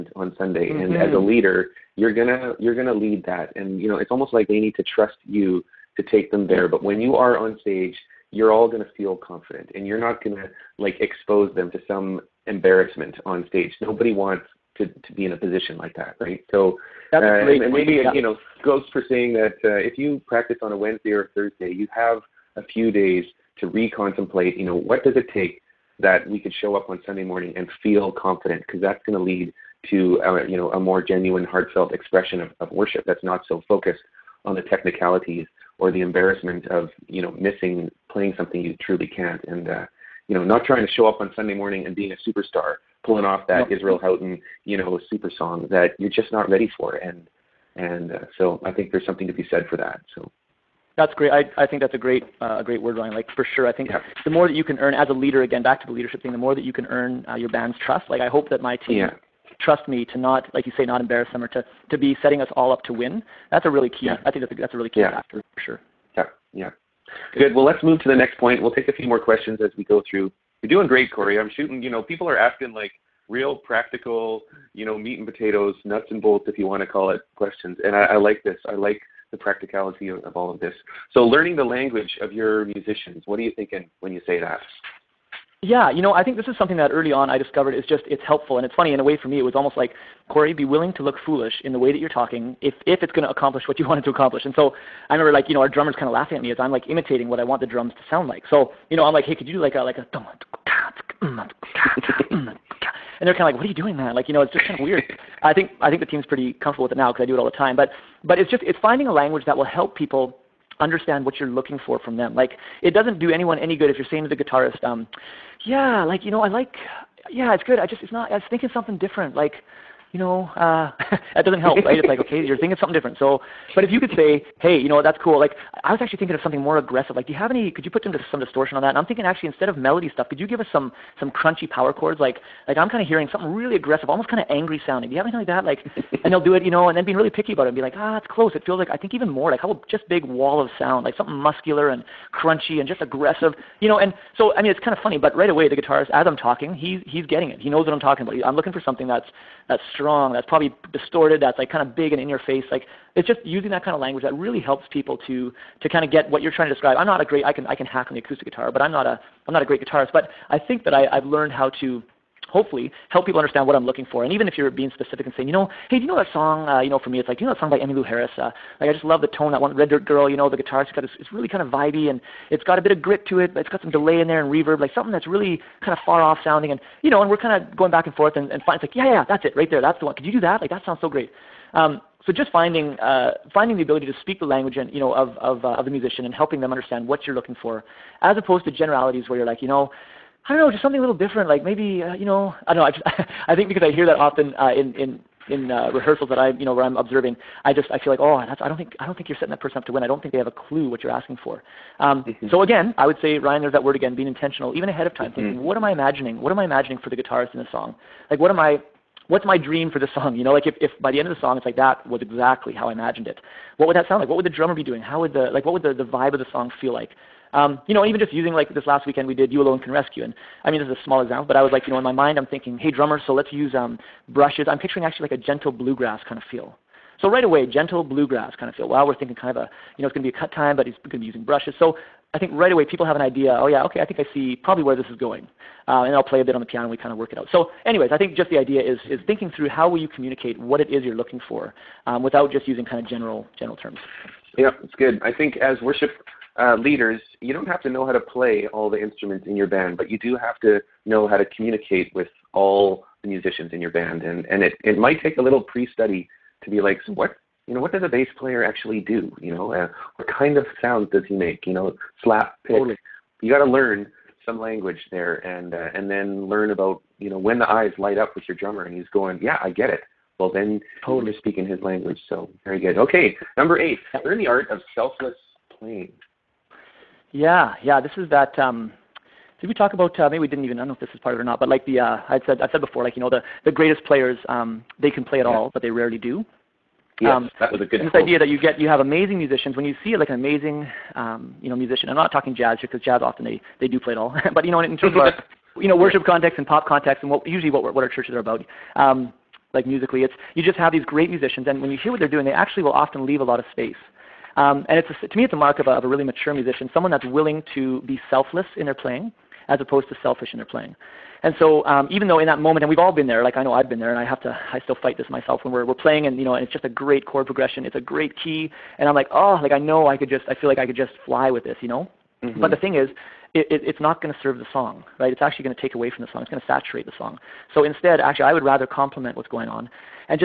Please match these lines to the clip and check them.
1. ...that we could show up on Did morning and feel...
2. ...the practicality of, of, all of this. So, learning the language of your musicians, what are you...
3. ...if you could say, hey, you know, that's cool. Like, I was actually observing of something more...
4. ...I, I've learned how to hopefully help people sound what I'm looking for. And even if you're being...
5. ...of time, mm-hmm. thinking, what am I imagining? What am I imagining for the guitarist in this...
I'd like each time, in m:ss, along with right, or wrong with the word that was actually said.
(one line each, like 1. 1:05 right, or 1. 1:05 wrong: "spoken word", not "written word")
1. 0:25 wrong: "Sunday", not "Did"
2. 1:19 right
3. 2:03 wrong: "thinking", not "observing"
4. 2:40 wrong: "understand", not "sound"
5. 3:25 right.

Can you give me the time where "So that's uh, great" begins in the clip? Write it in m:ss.
0:16.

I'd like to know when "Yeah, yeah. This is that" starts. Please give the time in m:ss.
4:37.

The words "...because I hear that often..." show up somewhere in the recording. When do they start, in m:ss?
3:13.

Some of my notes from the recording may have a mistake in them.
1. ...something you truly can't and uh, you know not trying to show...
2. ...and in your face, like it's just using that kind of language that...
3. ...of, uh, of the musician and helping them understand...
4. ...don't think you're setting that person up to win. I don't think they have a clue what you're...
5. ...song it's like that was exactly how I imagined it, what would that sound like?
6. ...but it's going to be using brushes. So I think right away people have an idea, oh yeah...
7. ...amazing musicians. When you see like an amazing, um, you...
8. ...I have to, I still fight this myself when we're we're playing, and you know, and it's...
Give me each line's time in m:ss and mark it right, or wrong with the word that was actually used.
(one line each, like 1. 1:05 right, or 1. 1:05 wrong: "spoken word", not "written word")
1. 0:38 right
2. 2:32 right
3. 3:05 right
4. 3:19 right
5. 3:31 right
6. 3:50 right
7. 4:48 right
8. 5:14 right.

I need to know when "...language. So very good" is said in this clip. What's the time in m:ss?
4:31.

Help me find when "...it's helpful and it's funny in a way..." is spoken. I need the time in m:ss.
1:28.